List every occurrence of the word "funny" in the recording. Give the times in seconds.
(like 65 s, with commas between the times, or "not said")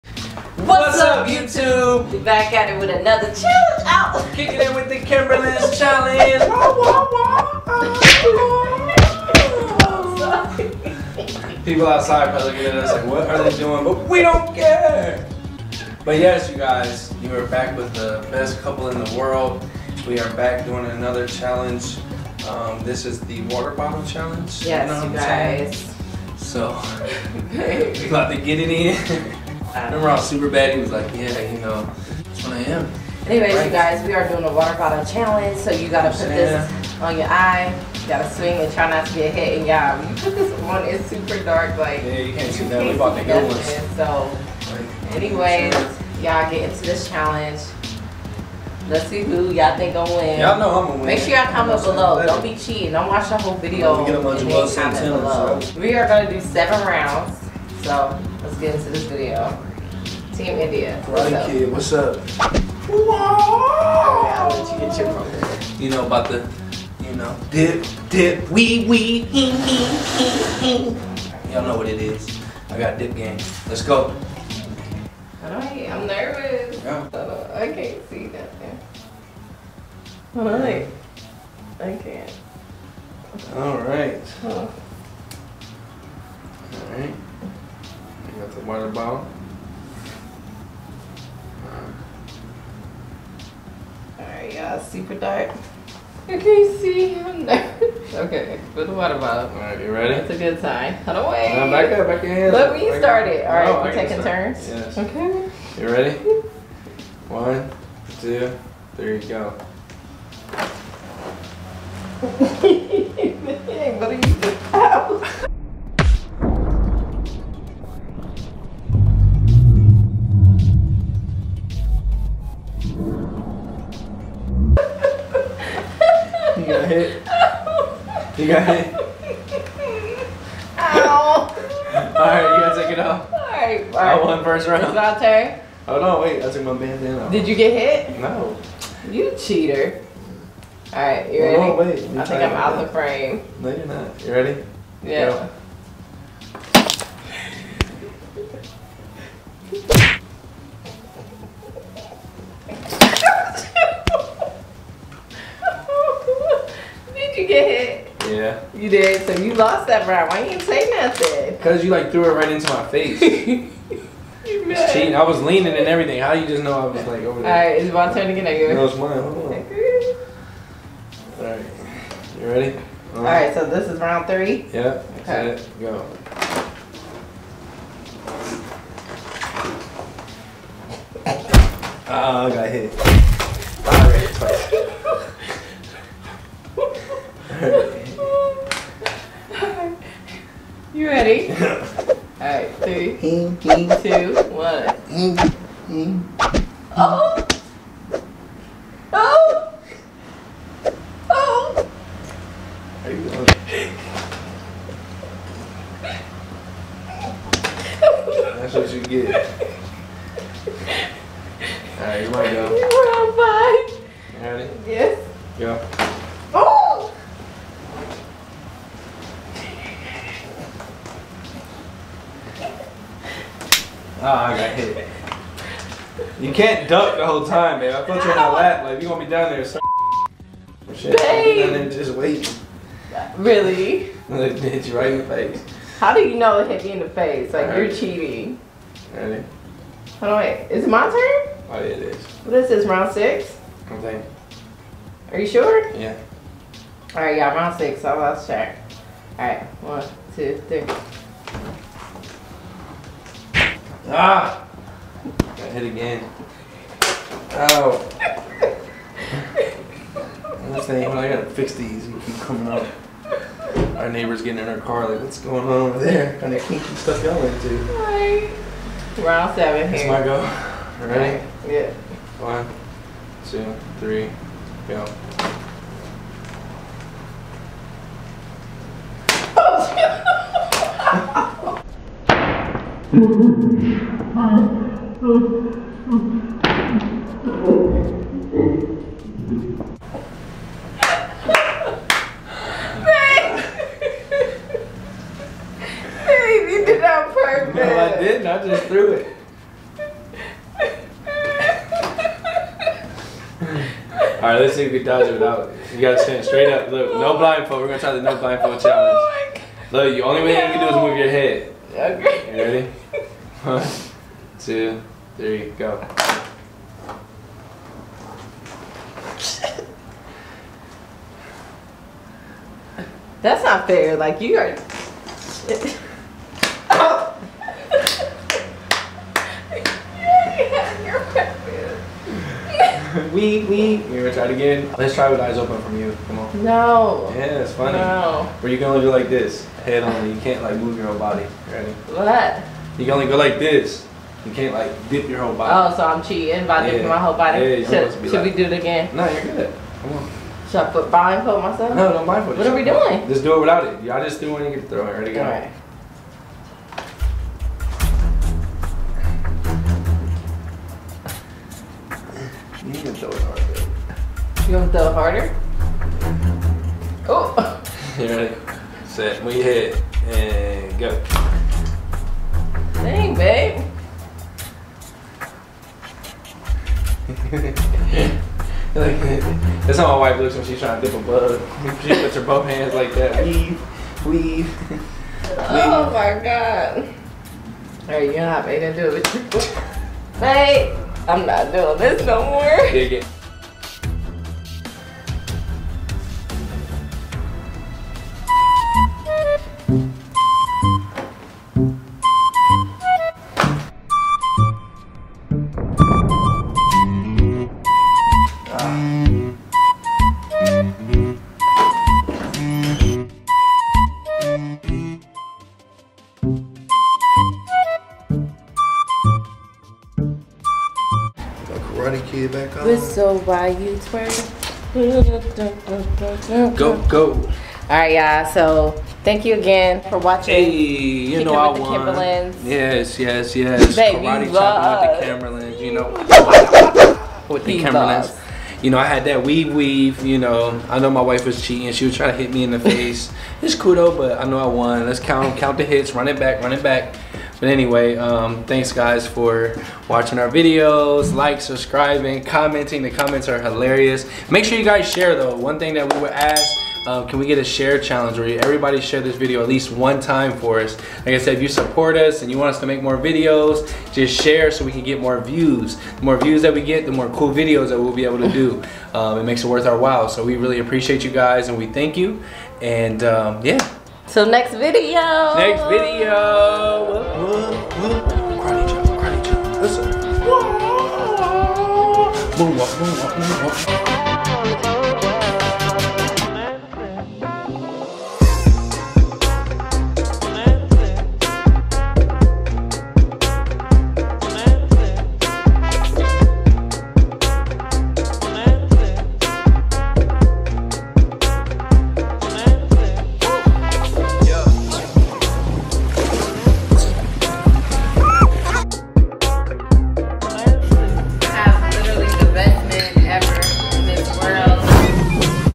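337 s.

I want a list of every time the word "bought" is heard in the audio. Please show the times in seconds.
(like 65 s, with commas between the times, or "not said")
42 s.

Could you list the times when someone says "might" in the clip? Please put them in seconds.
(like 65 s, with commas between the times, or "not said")
212 s.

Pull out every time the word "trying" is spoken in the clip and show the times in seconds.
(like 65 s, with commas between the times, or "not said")
380 s, 442 s.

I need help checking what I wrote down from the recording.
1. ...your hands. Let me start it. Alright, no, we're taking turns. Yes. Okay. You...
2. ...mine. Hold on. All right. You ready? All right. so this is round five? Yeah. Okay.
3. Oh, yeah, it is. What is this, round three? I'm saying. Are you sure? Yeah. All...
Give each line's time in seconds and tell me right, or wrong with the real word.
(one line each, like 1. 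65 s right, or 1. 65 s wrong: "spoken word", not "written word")
1. 102 s right
2. 168 s wrong: "three", not "five"
3. 241 s wrong: "six", not "three".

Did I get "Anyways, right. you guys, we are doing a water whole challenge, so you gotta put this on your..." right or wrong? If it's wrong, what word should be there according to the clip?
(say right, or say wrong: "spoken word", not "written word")
wrong: "bottle", not "whole".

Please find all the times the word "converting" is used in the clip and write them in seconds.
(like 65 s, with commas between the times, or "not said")
not said.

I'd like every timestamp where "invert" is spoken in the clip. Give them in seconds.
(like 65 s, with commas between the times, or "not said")
not said.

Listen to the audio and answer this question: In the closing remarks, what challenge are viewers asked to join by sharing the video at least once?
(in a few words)
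Share challenge.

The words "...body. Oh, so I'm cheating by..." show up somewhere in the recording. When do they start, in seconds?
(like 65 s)
345 s.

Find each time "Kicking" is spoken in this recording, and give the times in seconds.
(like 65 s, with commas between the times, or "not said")
4 s.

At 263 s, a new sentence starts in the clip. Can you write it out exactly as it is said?
Our neighbor's getting in our car, like, what's going on over there?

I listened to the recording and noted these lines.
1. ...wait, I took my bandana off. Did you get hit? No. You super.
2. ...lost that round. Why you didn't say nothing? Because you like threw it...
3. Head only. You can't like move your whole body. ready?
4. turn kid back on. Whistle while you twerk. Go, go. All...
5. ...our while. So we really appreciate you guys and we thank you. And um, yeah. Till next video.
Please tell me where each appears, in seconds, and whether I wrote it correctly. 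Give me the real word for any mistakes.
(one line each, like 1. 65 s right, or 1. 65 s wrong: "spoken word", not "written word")
1. 136 s wrong: "cheater", not "super"
2. 159 s right
3. 339 s right
4. 422 s right
5. 469 s right.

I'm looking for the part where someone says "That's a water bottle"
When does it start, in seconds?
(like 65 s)
88 s.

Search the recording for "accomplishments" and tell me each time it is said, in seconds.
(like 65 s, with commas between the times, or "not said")
not said.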